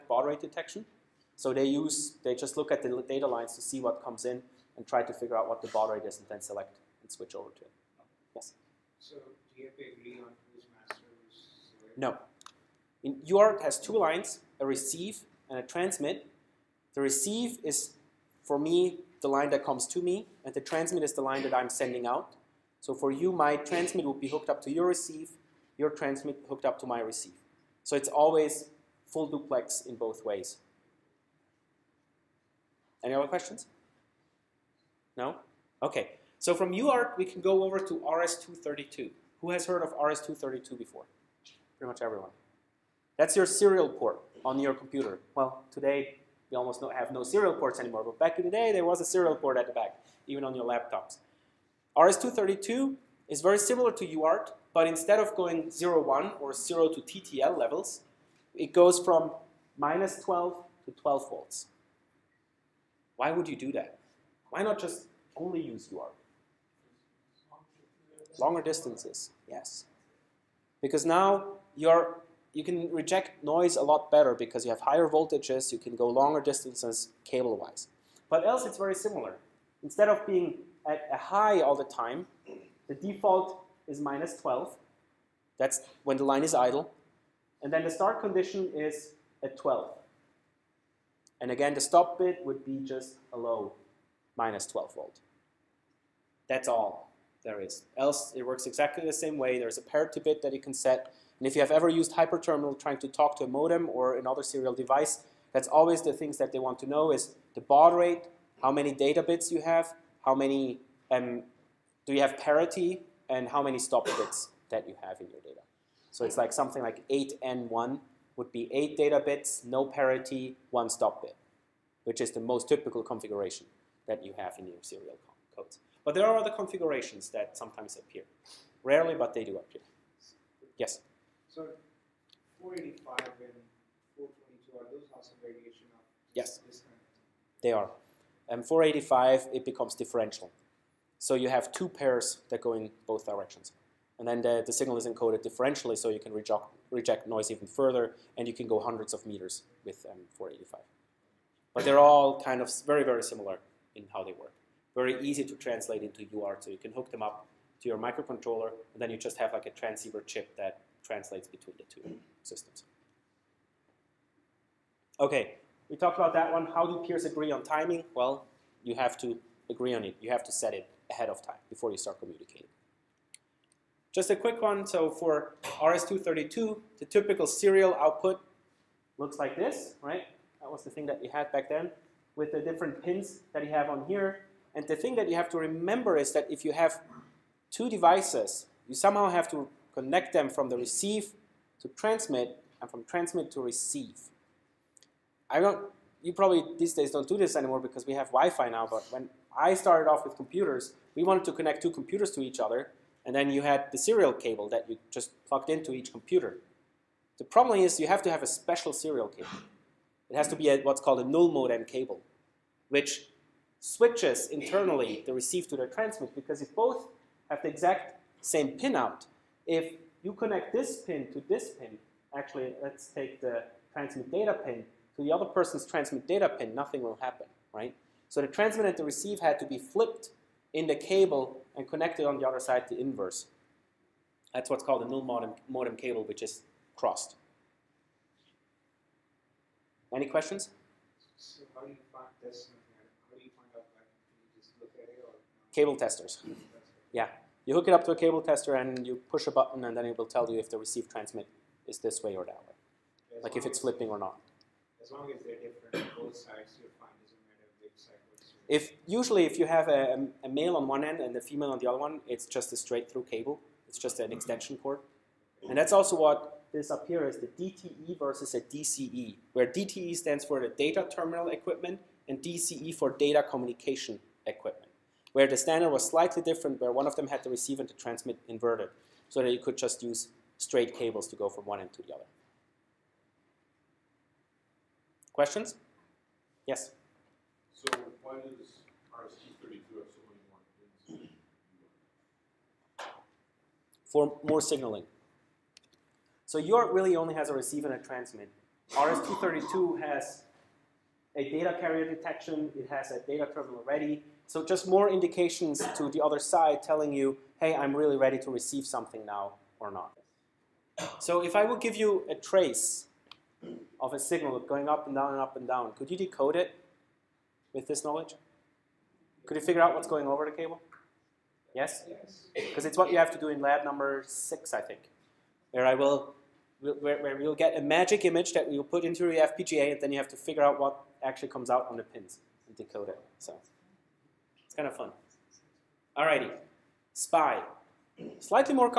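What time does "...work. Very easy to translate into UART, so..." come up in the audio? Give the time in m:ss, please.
2:34.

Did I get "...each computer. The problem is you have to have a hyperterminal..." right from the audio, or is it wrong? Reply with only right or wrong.
wrong.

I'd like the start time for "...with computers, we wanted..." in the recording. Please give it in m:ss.
3:20.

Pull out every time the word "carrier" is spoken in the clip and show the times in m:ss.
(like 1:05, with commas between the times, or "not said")
5:01.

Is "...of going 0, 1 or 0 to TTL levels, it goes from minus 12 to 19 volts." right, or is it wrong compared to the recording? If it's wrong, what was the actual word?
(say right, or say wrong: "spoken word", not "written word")
wrong: "12", not "19".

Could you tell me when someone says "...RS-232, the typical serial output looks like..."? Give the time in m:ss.
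2:55.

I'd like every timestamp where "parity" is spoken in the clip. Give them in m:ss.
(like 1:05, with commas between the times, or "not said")
1:39, 1:52, 1:59.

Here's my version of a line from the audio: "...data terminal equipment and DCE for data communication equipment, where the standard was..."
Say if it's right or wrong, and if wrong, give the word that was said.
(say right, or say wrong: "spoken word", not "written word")
right.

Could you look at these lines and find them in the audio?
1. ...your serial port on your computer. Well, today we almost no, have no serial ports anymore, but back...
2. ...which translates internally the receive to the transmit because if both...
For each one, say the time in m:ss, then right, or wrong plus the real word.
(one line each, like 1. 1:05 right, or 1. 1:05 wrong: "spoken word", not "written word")
1. 0:43 right
2. 3:32 wrong: "switches", not "translates".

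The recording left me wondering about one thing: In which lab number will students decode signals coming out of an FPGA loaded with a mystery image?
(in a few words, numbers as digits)
6.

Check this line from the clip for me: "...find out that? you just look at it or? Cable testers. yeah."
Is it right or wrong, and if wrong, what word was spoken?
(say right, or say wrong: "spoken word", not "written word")
right.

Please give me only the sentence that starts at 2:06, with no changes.
But there are other configurations that sometimes appear.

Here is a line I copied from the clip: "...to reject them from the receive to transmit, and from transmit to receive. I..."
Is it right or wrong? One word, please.
wrong.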